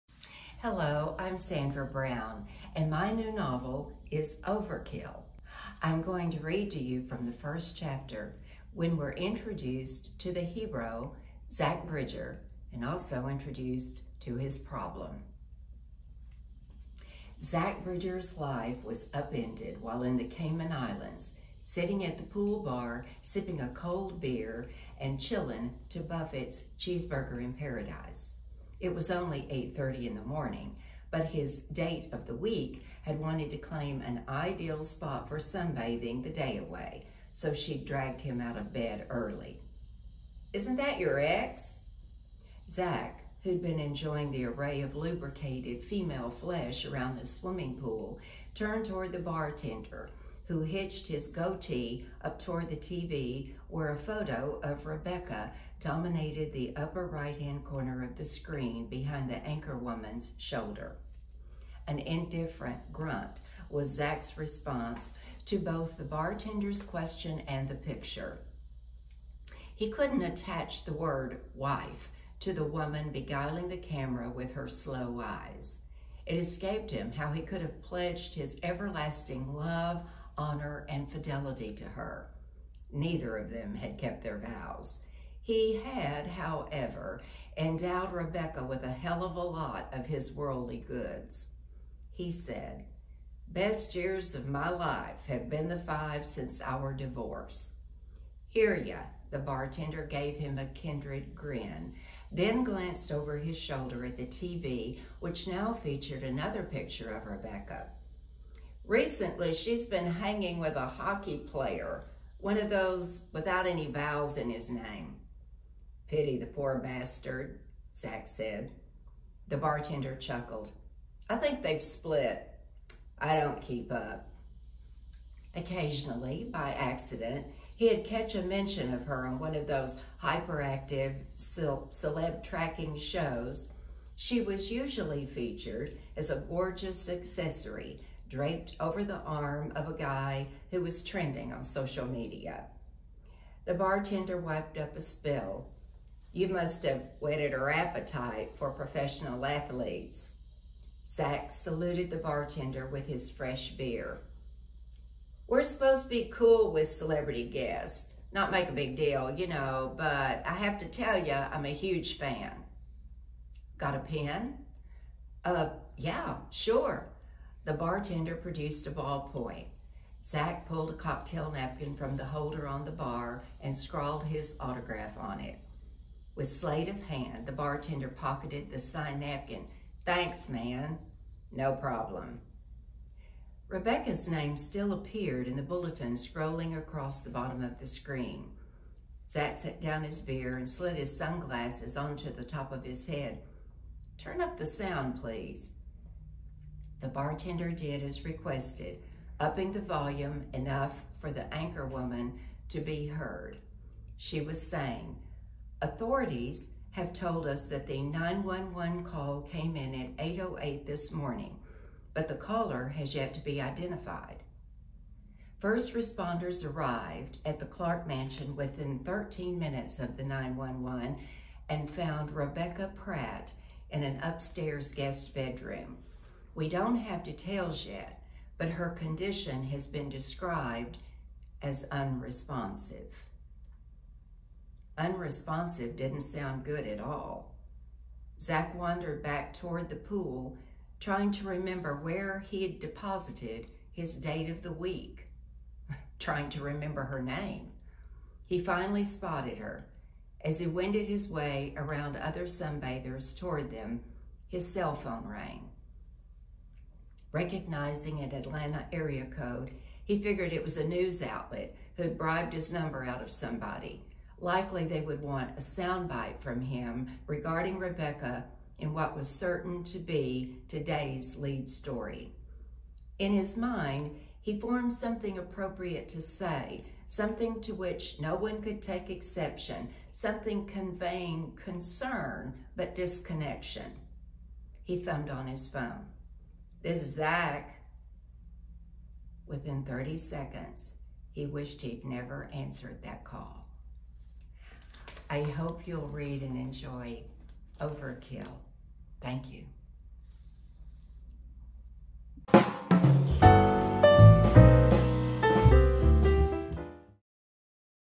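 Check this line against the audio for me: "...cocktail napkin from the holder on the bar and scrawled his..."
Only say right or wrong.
right.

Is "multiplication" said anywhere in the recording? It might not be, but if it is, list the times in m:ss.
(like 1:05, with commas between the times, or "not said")
not said.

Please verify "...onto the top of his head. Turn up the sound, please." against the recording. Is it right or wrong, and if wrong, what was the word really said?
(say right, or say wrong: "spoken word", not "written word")
right.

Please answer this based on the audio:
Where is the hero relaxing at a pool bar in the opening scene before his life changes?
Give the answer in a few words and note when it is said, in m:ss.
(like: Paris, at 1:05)
Cayman Islands, at 0:20.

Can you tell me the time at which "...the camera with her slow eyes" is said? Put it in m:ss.
1:13.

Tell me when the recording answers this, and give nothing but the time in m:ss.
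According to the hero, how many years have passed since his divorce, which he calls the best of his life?
1:35.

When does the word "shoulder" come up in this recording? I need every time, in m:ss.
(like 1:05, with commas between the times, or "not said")
1:00, 1:43.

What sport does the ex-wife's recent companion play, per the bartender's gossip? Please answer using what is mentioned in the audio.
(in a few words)
Hockey.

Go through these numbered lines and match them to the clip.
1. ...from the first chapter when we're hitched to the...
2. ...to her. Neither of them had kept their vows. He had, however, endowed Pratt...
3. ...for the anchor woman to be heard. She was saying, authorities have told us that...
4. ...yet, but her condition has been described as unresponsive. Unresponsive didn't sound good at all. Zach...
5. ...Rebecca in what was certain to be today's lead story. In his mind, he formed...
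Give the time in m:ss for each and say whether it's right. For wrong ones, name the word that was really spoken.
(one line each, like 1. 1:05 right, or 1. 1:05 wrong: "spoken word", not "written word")
1. 0:07 wrong: "introduced", not "hitched"
2. 1:21 wrong: "Rebecca", not "Pratt"
3. 3:21 right
4. 3:47 right
5. 4:27 right.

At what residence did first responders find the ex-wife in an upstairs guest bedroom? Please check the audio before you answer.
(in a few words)
Clark Mansion.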